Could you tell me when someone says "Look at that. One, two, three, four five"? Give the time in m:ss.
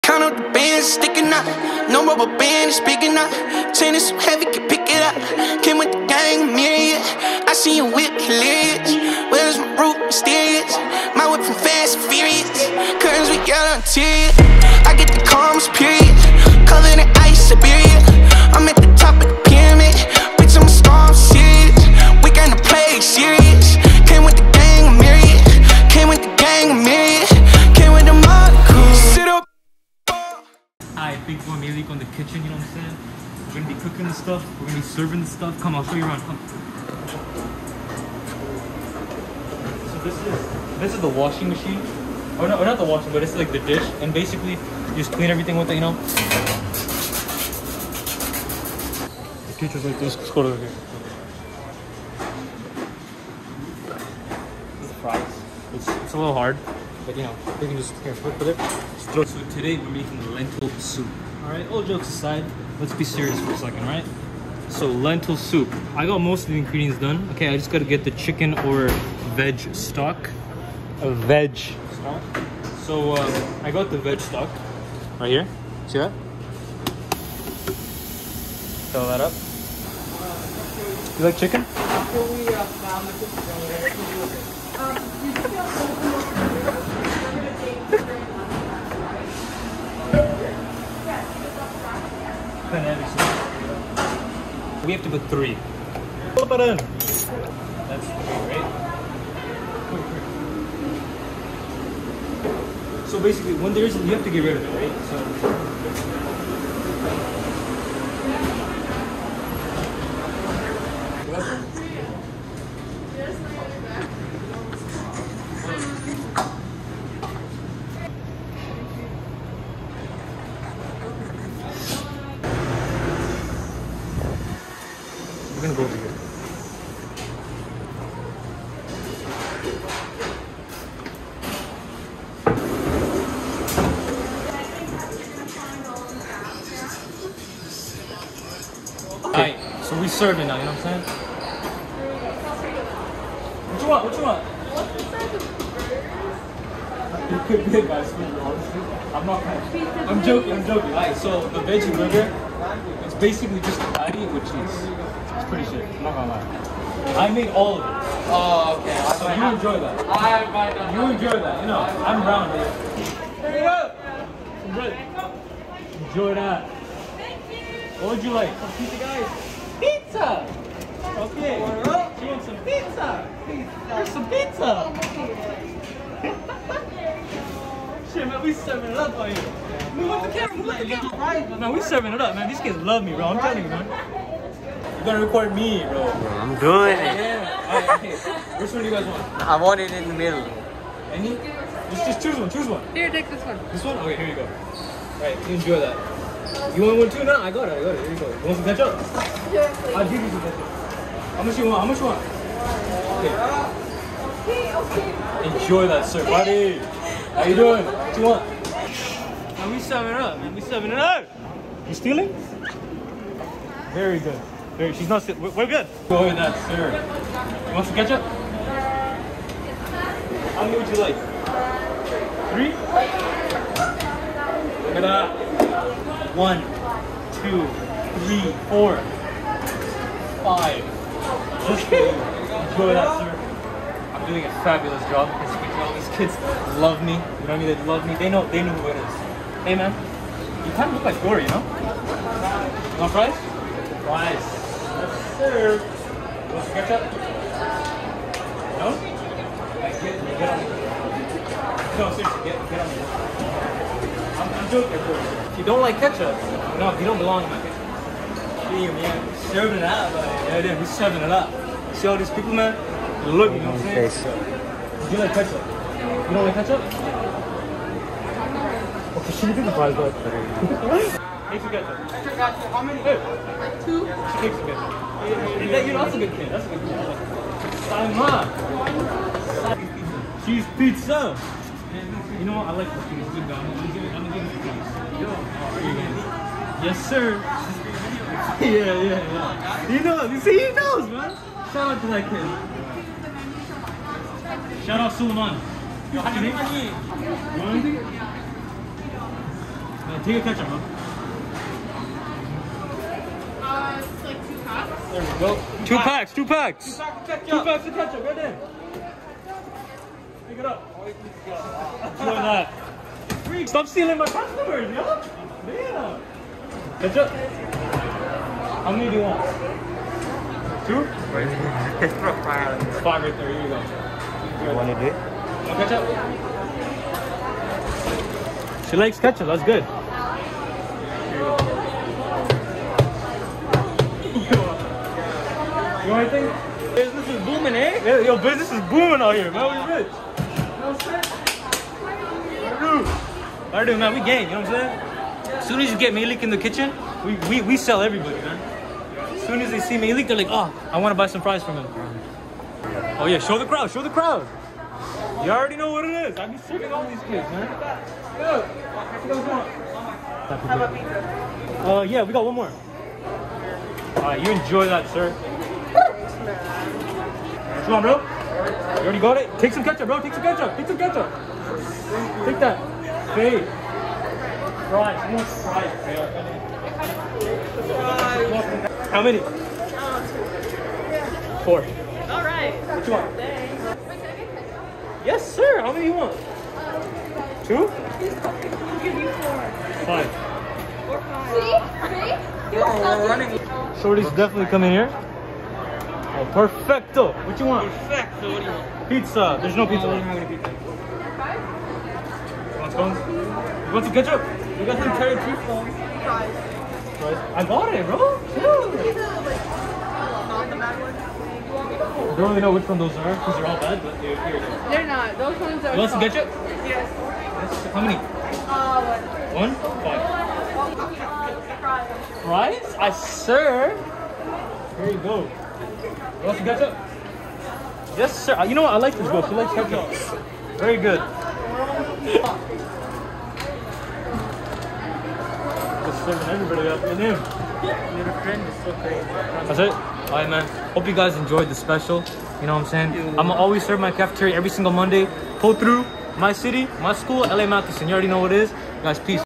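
3:44.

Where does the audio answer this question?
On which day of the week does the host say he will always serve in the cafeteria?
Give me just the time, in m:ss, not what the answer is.
7:24.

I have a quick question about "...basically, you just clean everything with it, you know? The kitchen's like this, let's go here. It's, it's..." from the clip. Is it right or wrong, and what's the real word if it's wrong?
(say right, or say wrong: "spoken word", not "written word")
right.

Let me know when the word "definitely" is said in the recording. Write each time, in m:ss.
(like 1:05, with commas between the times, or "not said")
6:34.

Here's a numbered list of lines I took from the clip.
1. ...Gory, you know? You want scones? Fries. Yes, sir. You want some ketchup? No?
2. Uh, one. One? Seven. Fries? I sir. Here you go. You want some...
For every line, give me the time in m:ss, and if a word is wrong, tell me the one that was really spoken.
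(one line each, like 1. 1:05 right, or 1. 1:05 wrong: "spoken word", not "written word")
1. 4:01 wrong: "fries", not "scones"
2. 6:58 wrong: "Five", not "Seven".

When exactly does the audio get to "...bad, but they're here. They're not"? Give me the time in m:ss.
6:53.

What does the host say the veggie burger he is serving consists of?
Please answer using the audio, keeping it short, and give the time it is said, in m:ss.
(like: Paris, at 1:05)
Patty with cheese, at 2:33.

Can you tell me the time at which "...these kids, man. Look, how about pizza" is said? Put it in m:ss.
5:57.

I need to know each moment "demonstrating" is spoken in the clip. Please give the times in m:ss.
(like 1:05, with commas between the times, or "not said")
not said.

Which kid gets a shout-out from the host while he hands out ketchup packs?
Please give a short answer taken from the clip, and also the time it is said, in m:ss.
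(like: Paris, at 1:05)
Suleiman, at 4:54.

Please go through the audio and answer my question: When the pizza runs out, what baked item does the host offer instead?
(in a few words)
Cherry cheese scones.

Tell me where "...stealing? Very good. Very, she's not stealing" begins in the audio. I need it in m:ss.
3:31.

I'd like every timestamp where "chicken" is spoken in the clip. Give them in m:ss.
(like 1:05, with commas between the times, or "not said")
1:08, 1:21.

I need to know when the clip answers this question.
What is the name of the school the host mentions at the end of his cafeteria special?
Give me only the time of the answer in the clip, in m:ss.
7:27.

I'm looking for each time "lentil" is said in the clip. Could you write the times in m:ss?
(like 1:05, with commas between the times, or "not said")
1:00, 1:04.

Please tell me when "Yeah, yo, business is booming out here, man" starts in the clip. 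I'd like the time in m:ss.
5:38.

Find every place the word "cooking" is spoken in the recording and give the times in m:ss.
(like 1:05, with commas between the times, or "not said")
0:33, 4:42.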